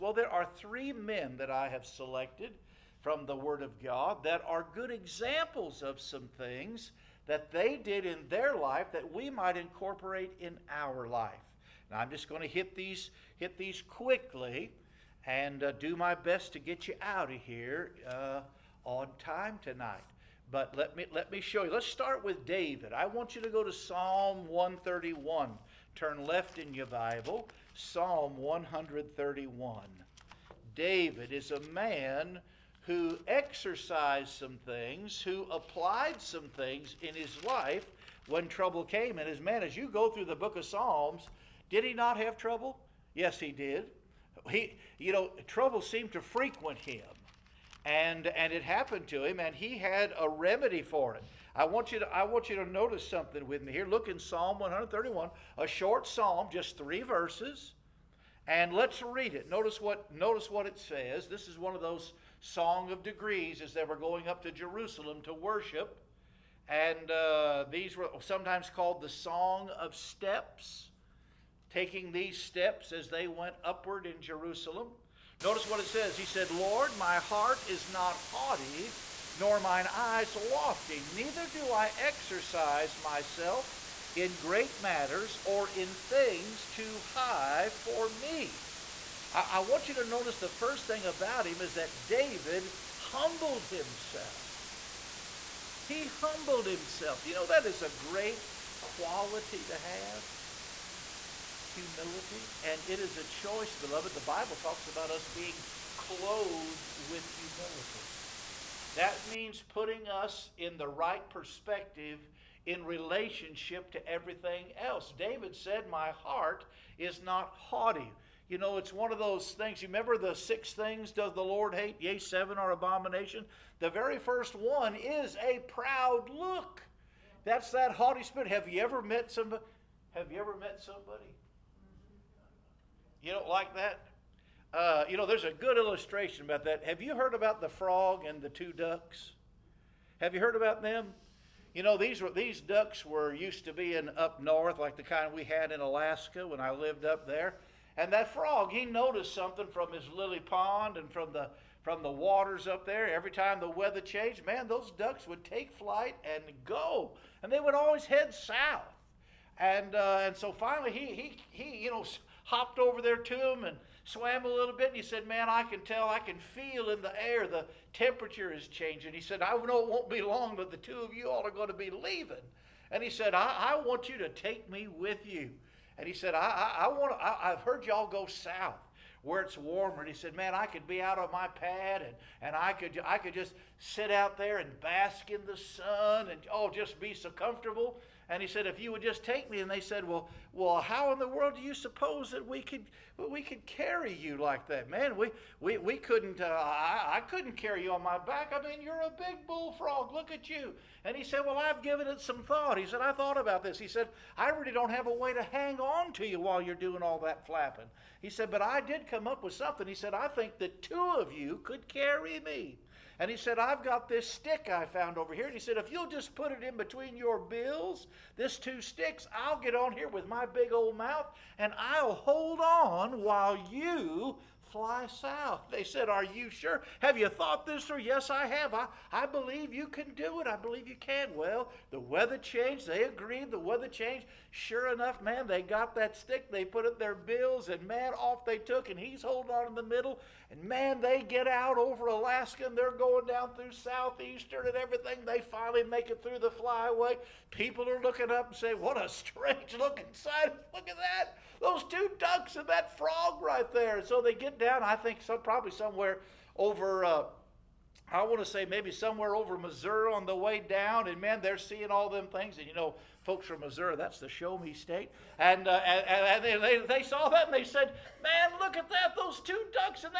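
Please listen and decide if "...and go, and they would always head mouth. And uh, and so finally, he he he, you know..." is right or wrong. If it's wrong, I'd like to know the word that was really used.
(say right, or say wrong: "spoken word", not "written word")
wrong: "south", not "mouth".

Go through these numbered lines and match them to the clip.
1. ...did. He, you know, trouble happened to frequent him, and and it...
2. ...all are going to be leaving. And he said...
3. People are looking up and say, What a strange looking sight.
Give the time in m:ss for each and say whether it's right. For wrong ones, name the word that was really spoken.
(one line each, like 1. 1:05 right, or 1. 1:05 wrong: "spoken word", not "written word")
1. 0:43 wrong: "seemed", not "happened"
2. 2:51 right
3. 4:07 right.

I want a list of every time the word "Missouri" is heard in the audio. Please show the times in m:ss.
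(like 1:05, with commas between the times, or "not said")
4:19, 4:23.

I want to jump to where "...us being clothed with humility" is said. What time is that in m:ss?
1:45.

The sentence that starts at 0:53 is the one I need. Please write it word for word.
Look in Psalm 131, a short psalm, just three verses.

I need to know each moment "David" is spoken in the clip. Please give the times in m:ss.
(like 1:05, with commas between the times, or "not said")
0:22, 0:30, 1:32, 1:55.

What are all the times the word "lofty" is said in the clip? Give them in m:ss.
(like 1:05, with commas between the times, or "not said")
1:20.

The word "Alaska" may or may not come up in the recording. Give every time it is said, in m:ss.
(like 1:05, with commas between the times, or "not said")
2:25, 4:02.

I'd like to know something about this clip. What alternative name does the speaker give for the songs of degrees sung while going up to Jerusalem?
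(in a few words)
Song of Steps.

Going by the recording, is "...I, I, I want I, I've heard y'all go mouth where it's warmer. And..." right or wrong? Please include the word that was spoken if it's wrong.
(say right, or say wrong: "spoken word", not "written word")
wrong: "south", not "mouth".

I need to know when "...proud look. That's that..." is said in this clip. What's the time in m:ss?
2:05.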